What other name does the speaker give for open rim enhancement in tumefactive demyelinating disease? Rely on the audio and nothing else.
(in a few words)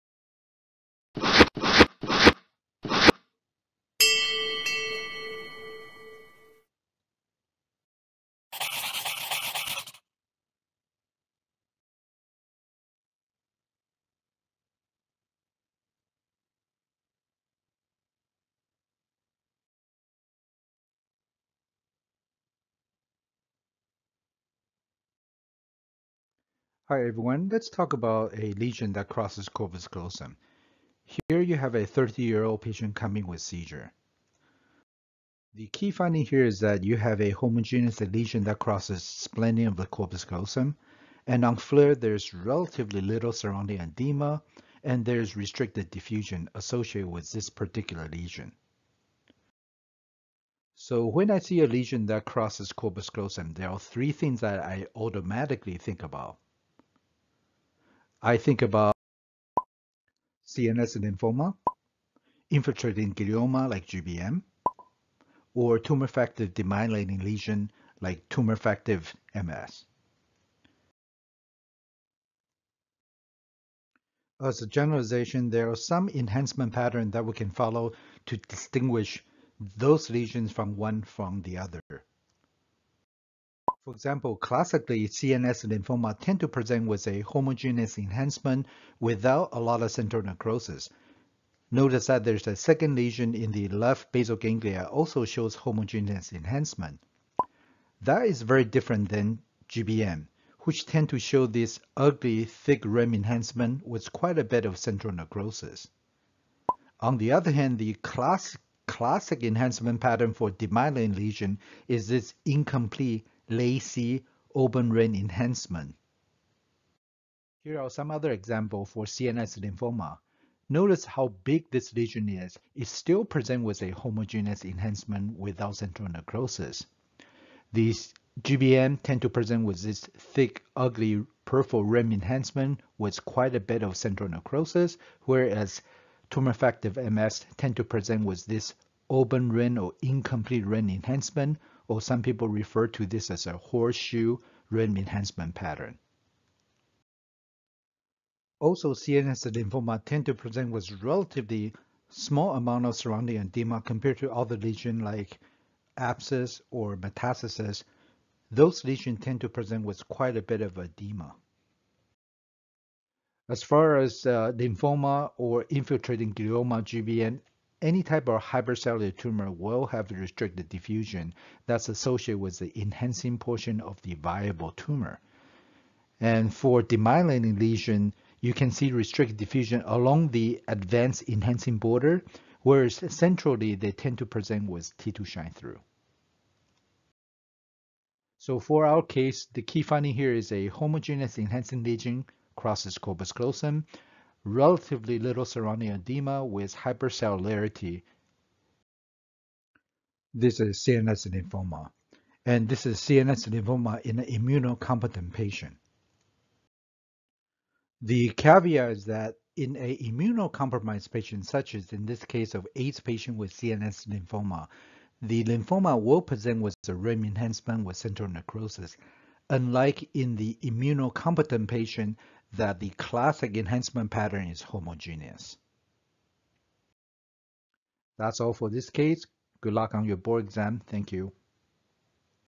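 Horseshoe rim enhancement.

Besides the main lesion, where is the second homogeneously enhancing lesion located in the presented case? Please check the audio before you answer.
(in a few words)
Left basal ganglia.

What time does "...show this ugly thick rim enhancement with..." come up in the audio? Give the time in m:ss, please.
1:41.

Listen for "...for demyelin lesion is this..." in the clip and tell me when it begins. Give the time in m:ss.
1:50.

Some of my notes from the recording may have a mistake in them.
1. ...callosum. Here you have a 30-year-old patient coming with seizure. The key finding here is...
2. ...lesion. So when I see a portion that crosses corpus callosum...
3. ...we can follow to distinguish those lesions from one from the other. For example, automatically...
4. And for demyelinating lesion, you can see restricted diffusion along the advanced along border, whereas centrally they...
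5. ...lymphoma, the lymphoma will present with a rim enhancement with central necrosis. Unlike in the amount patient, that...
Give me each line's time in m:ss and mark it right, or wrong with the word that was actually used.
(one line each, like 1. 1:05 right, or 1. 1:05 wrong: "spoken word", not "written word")
1. 0:29 right
2. 0:48 wrong: "lesion", not "portion"
3. 1:17 wrong: "classically", not "automatically"
4. 2:56 wrong: "enhancing", not "along"
5. 3:34 wrong: "immunocompetent", not "amount".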